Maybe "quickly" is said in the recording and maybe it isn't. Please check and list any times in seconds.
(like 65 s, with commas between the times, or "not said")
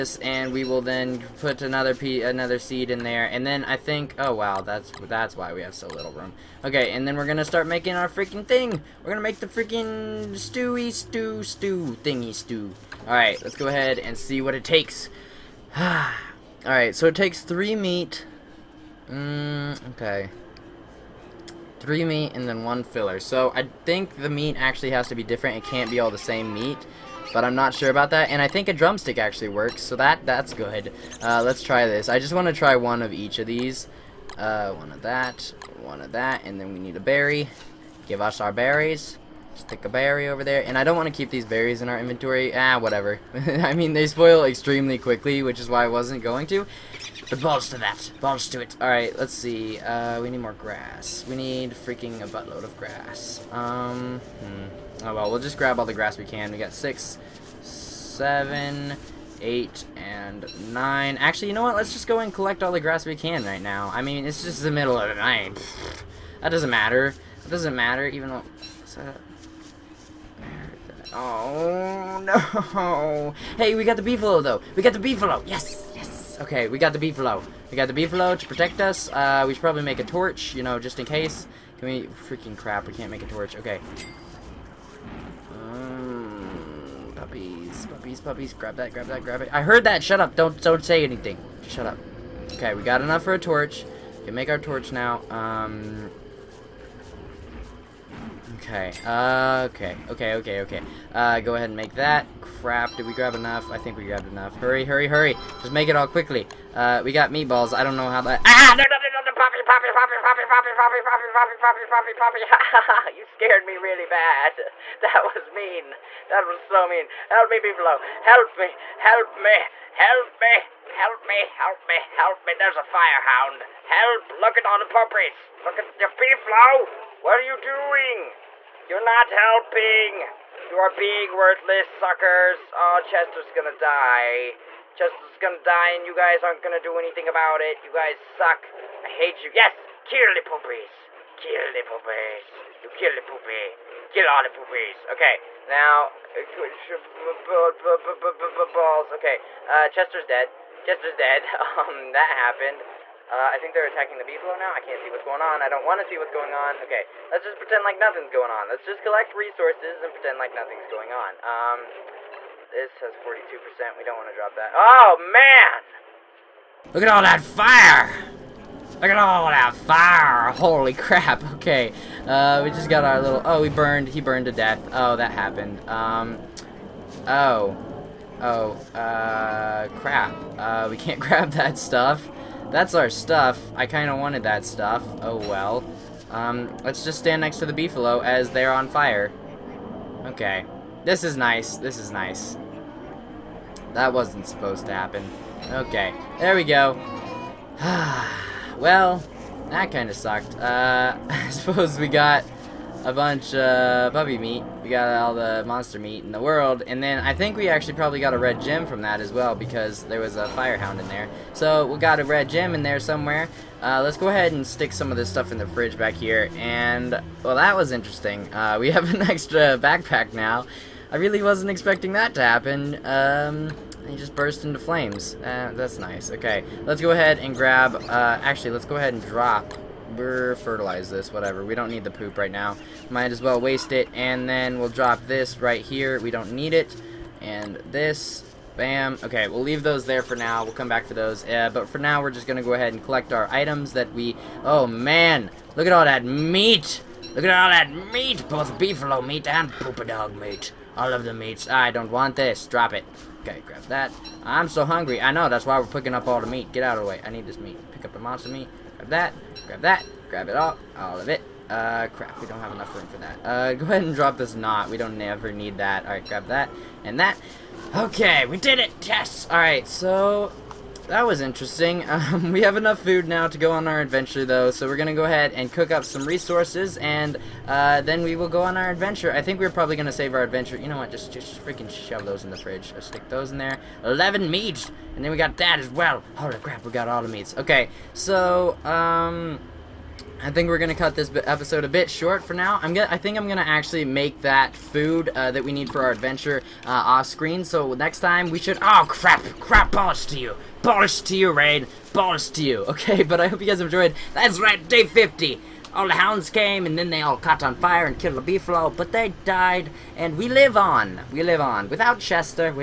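44 s, 106 s.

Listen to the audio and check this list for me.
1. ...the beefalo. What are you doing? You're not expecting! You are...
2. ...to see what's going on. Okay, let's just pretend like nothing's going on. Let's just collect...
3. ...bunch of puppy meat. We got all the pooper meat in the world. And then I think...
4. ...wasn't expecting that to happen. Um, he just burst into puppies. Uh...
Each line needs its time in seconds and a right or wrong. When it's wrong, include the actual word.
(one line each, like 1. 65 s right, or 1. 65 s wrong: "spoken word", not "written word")
1. 125 s wrong: "helping", not "expecting"
2. 156 s right
3. 203 s wrong: "monster", not "pooper"
4. 221 s wrong: "flames", not "puppies".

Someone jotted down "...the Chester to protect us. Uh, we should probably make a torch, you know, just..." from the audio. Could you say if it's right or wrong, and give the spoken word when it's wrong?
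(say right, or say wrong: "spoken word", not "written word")
wrong: "Beefalo", not "Chester".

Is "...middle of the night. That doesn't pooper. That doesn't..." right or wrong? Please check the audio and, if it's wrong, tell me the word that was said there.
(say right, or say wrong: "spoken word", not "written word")
wrong: "matter", not "pooper".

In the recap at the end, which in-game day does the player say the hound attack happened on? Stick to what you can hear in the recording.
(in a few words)
day 50.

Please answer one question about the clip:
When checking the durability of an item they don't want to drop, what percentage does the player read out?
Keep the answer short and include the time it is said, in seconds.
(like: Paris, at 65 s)
42%, at 163 s.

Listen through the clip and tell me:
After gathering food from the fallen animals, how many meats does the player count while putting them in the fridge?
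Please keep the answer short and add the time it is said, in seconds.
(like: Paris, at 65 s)
11, at 284 s.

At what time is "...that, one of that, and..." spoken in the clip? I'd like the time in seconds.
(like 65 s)
35 s.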